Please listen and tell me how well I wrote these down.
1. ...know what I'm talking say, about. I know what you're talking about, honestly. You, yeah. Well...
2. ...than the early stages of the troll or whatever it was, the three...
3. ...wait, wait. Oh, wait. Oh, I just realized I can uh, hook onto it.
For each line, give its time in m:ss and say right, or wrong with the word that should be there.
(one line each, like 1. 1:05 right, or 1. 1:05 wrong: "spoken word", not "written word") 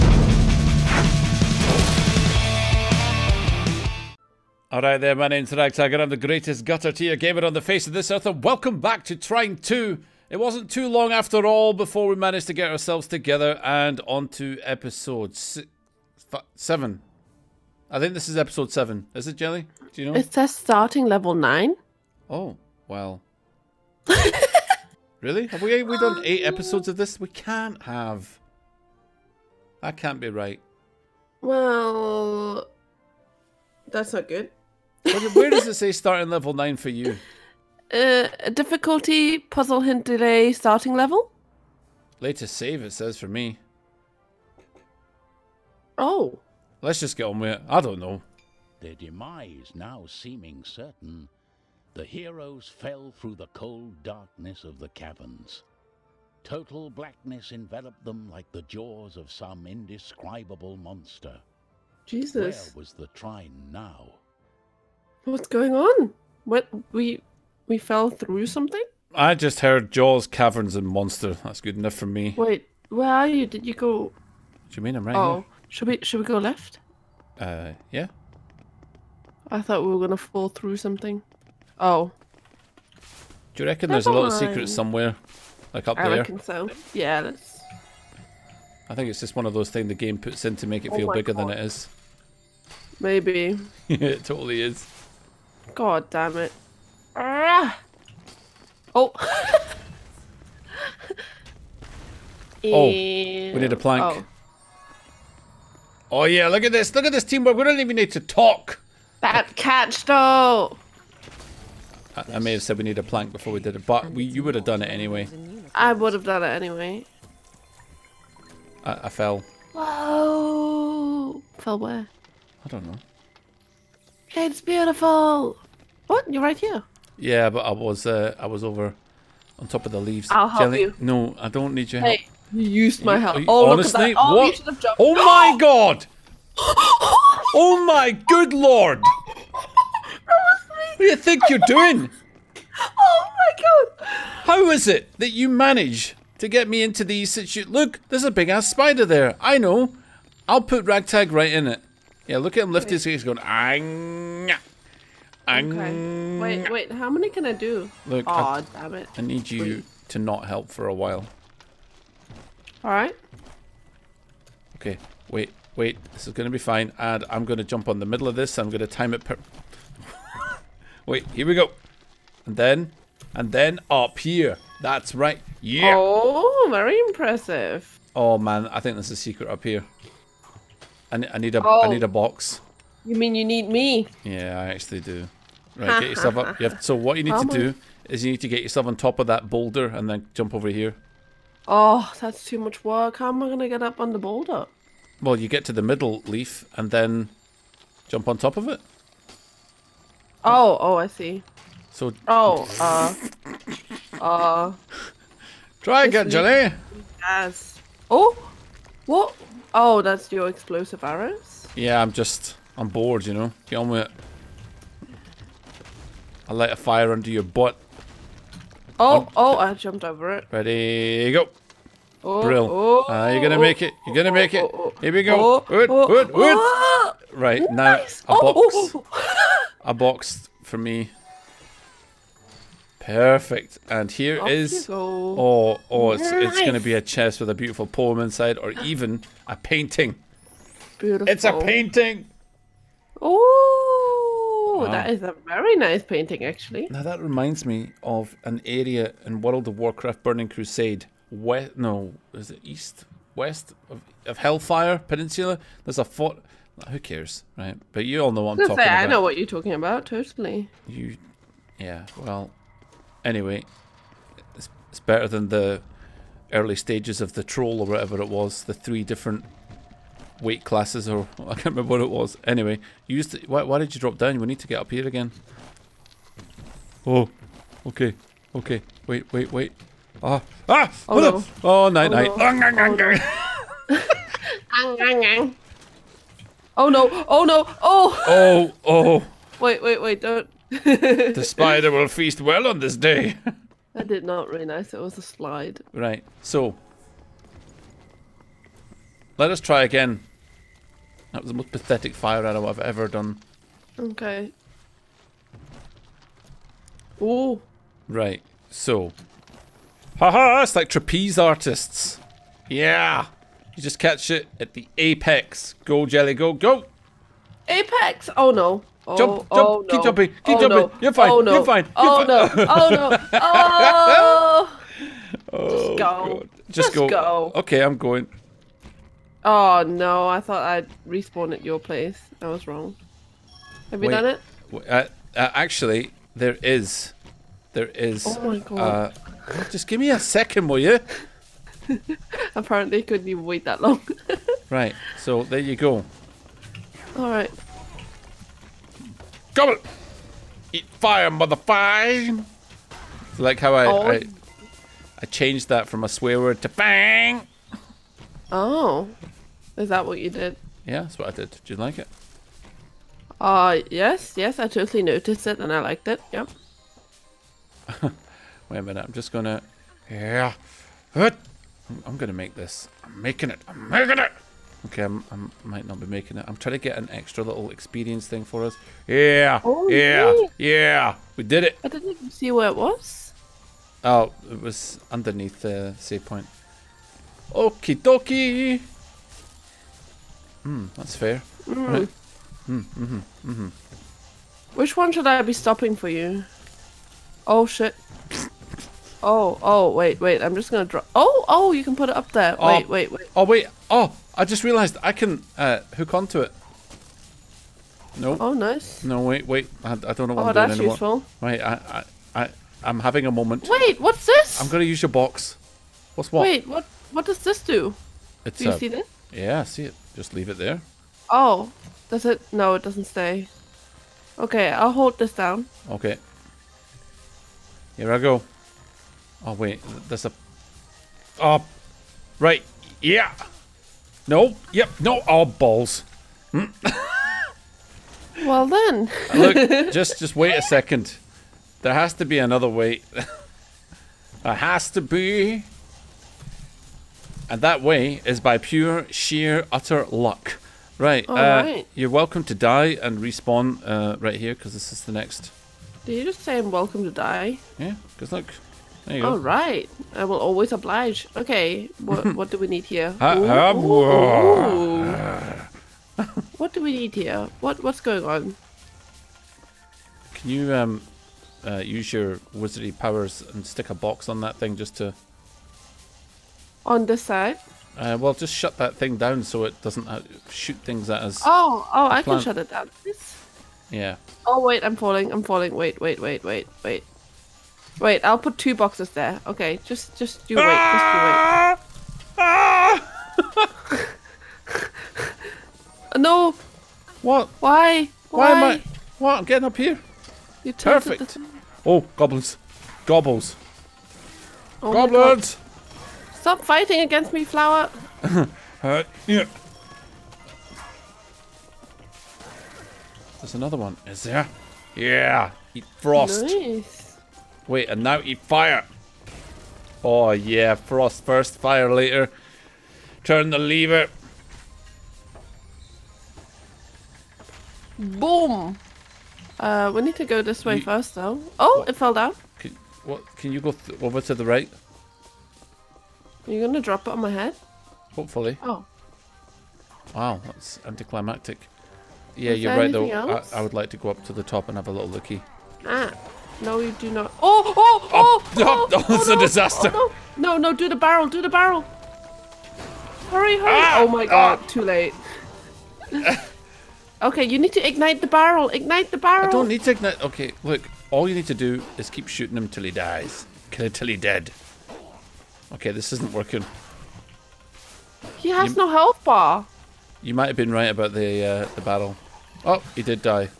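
1. 4:18 wrong: "totally", not "honestly"
2. 4:25 right
3. 6:42 right.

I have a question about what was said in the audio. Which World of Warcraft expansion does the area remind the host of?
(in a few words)
Burning Crusade.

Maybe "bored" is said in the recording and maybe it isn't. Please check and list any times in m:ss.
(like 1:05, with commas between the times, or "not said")
3:32.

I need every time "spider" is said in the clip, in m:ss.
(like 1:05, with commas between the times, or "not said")
2:28, 4:51.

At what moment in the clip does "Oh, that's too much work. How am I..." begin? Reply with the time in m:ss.
3:11.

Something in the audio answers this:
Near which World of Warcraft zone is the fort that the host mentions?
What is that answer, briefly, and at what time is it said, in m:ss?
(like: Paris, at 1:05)
Hellfire Peninsula, at 4:14.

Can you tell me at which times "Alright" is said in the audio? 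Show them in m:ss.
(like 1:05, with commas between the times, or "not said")
2:42, 5:47.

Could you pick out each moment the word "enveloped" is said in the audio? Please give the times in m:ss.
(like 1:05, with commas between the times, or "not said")
0:57.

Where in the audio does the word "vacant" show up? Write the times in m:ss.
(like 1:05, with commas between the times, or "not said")
not said.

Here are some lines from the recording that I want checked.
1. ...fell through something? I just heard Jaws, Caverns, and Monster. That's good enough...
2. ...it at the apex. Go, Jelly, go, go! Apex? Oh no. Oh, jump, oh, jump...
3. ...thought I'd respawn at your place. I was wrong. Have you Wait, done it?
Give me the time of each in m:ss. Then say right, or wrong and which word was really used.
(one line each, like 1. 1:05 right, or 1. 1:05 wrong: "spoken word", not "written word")
1. 1:07 right
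2. 5:14 right
3. 5:30 right.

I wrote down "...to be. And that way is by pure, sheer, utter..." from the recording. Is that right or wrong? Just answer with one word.
right.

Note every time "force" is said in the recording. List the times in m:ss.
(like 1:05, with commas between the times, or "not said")
not said.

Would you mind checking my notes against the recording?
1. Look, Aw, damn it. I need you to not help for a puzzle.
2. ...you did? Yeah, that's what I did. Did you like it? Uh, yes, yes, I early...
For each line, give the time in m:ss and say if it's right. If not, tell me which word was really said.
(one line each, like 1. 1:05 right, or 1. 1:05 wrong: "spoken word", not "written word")
1. 2:38 wrong: "while", not "puzzle"
2. 6:00 wrong: "totally", not "early".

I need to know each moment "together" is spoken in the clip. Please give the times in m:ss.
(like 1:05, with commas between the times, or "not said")
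0:13.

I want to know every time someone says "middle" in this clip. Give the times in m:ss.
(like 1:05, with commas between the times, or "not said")
2:48, 3:15.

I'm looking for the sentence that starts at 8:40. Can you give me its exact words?
Oh yeah, frost first, fire later.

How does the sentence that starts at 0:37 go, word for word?
Uh, difficulty, puzzle hint delay, starting level?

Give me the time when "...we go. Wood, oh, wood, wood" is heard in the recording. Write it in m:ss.
3:45.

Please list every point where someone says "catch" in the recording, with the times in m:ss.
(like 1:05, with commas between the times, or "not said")
1:49, 5:13.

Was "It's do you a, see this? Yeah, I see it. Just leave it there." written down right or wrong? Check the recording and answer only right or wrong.
right.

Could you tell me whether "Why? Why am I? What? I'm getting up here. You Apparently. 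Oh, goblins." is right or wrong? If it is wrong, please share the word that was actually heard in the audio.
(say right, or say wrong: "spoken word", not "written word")
wrong: "Perfect", not "Apparently".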